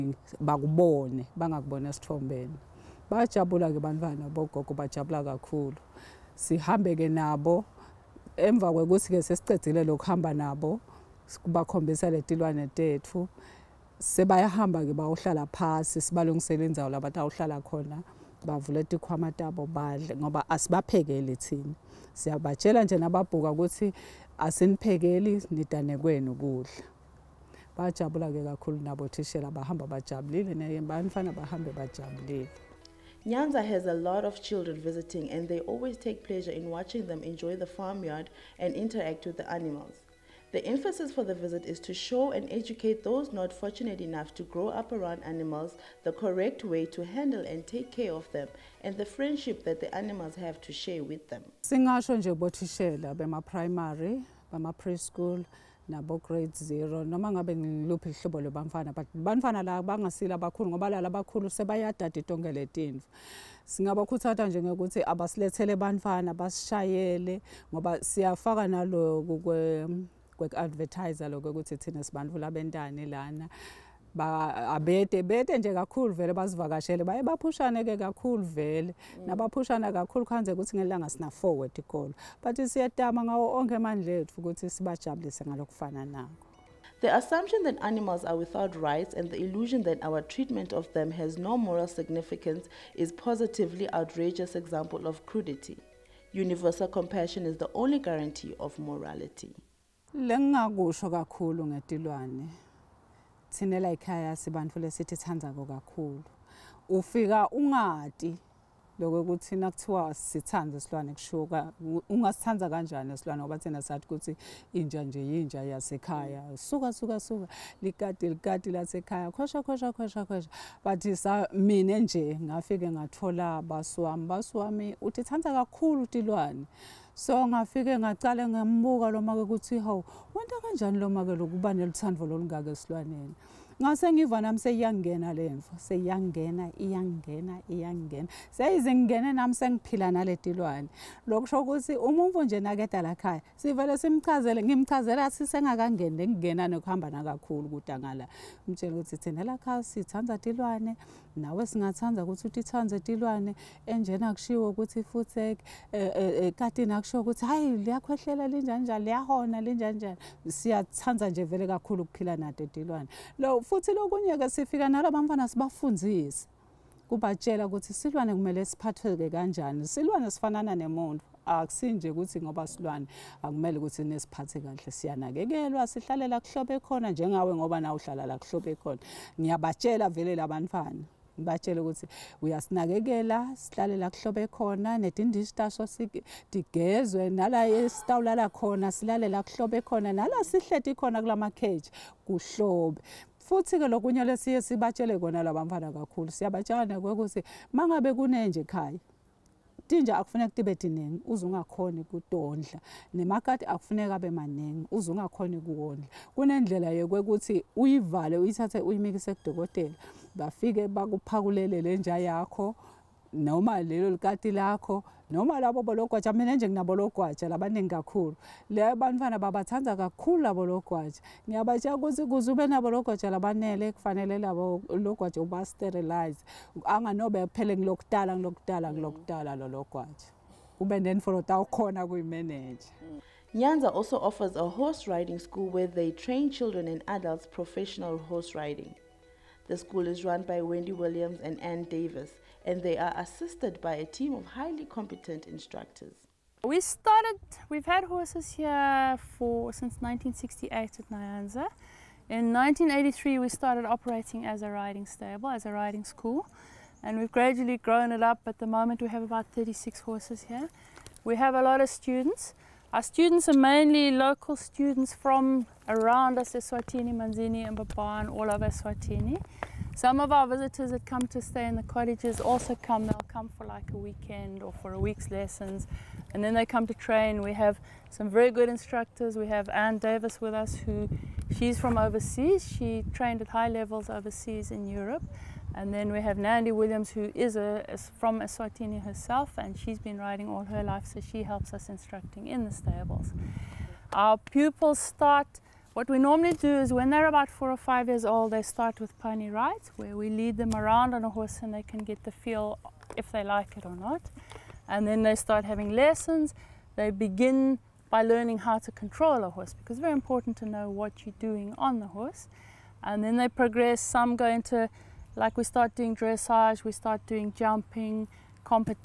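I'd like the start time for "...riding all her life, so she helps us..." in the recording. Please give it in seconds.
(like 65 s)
290 s.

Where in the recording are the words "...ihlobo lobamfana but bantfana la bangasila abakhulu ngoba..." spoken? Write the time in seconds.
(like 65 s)
58 s.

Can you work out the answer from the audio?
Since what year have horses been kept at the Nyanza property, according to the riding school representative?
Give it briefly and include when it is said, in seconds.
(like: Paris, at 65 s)
1968, at 249 s.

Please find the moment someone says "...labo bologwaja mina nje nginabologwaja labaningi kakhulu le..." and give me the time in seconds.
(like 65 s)
215 s.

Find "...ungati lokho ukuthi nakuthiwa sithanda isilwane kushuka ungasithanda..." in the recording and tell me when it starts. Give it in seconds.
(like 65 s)
107 s.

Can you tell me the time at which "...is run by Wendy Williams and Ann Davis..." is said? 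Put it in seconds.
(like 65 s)
240 s.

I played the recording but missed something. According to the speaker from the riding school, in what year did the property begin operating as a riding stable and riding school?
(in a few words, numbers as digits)
1983.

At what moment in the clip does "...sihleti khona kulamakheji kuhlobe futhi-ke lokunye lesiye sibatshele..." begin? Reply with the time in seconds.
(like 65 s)
190 s.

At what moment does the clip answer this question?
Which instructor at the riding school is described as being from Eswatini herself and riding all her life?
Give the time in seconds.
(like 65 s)
286 s.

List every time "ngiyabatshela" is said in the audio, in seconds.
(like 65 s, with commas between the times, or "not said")
179 s, 221 s.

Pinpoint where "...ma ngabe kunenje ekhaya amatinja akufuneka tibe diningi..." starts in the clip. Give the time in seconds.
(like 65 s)
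197 s.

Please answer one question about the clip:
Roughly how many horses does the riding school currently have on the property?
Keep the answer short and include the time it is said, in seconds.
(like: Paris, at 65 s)
36, at 259 s.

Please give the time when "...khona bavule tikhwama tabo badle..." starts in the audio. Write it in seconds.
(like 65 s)
17 s.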